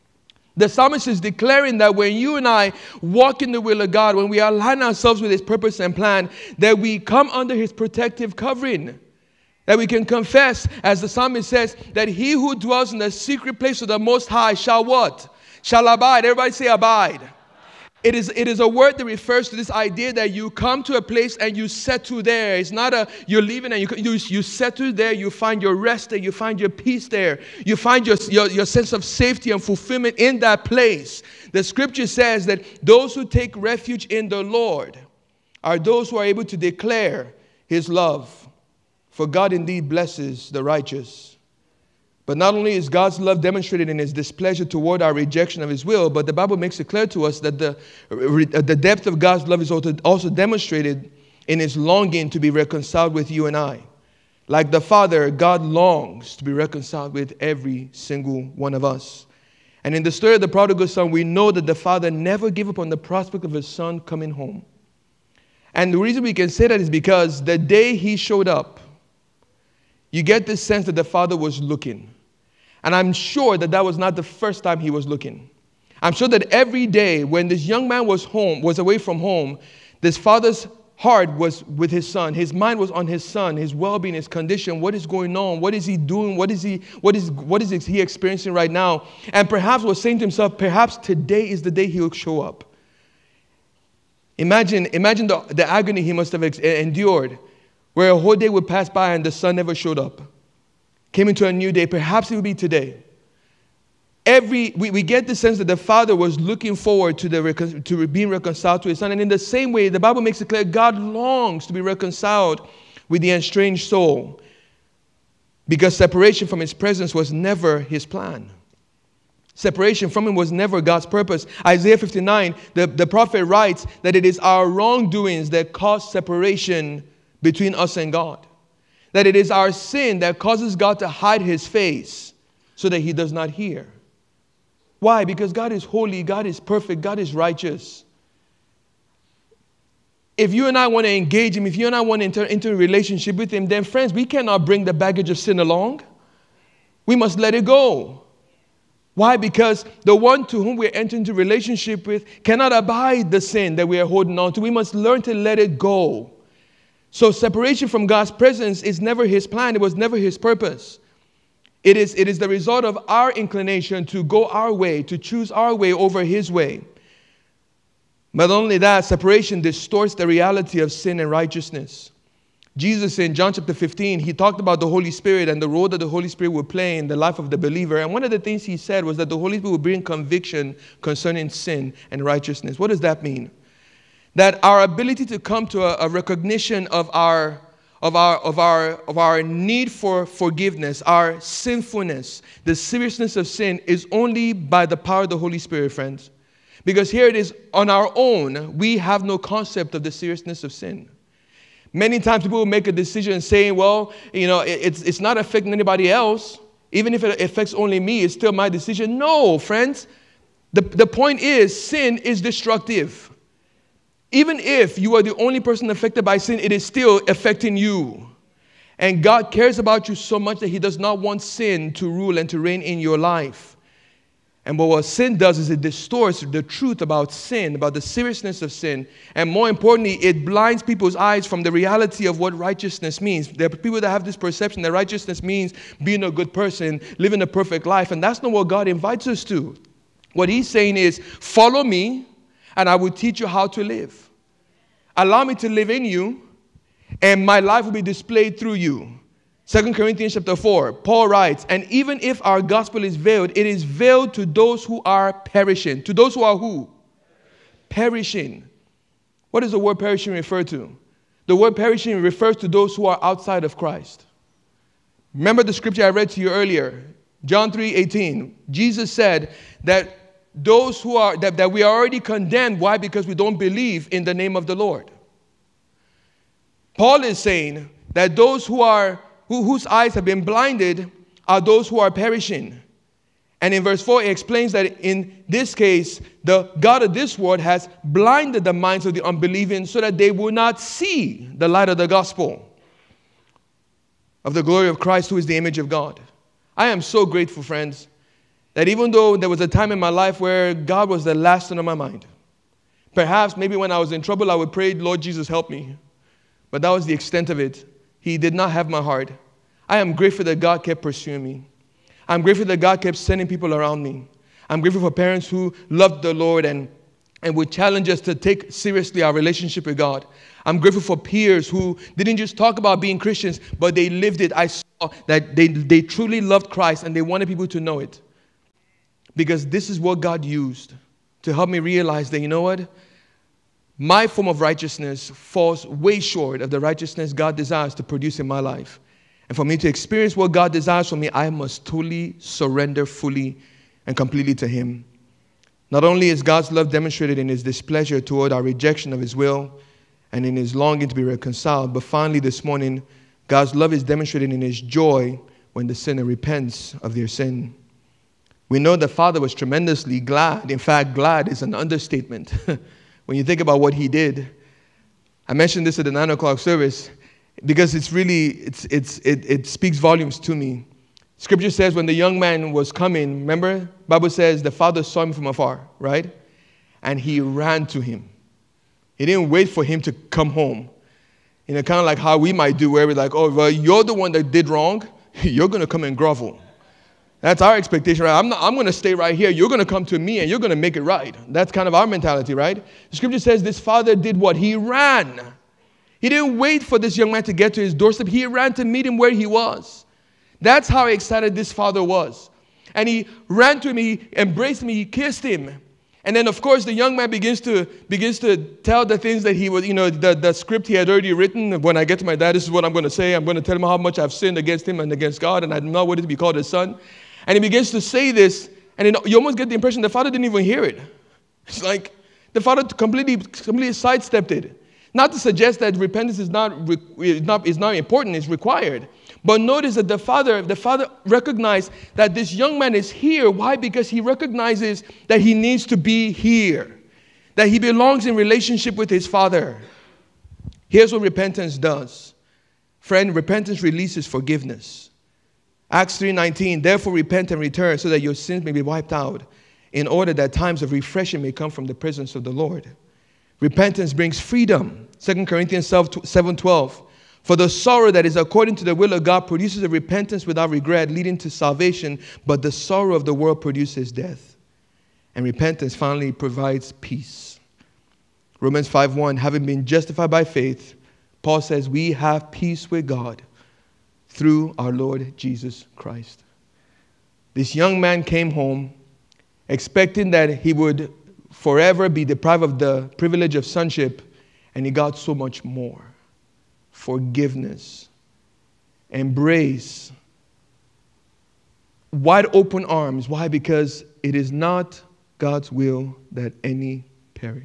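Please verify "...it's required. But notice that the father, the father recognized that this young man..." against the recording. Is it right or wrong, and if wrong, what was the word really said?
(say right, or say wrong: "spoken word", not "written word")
right.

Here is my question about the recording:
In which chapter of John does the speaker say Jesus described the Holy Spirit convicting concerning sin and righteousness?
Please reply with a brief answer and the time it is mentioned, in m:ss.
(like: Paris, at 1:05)
John 15, at 2:53.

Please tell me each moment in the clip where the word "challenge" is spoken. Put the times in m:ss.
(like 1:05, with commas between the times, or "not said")
5:17.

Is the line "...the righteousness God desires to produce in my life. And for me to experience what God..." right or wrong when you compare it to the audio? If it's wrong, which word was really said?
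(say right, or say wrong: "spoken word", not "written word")
right.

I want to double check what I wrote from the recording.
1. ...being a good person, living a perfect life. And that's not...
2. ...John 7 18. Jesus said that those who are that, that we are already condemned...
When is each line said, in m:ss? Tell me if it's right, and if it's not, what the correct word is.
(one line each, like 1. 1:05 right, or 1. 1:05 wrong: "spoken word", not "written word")
1. 3:56 right
2. 4:27 wrong: "3", not "7".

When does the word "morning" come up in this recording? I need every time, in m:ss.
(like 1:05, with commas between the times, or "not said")
5:52.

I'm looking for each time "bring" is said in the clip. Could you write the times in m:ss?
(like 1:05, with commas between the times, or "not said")
2:24, 2:59, 7:34.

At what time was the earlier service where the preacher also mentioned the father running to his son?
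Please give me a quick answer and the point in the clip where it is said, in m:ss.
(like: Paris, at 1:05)
Nine o'clock, at 6:06.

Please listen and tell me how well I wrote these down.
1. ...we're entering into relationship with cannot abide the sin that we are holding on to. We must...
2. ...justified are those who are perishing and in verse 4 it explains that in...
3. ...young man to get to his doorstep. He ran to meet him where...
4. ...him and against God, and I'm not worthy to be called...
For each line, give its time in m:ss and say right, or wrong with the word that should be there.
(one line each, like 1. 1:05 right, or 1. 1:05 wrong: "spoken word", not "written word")
1. 2:30 right
2. 4:40 wrong: "blinded", not "justified"
3. 6:37 right
4. 6:54 right.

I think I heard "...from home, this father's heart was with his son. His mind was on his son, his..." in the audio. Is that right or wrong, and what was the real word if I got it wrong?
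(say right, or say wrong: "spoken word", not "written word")
right.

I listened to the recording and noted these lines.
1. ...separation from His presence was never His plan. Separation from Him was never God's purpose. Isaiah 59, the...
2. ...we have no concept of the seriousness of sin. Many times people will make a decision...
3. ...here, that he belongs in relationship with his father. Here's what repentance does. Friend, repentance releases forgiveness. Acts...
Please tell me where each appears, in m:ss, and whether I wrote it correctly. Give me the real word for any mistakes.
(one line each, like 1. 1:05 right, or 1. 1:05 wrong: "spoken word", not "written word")
1. 1:55 right
2. 3:18 right
3. 7:16 right.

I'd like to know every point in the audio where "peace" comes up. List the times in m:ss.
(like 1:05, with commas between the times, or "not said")
0:26, 7:47, 7:52.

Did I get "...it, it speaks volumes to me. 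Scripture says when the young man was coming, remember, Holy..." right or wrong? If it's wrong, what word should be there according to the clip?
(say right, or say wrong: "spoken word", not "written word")
wrong: "Bible", not "Holy".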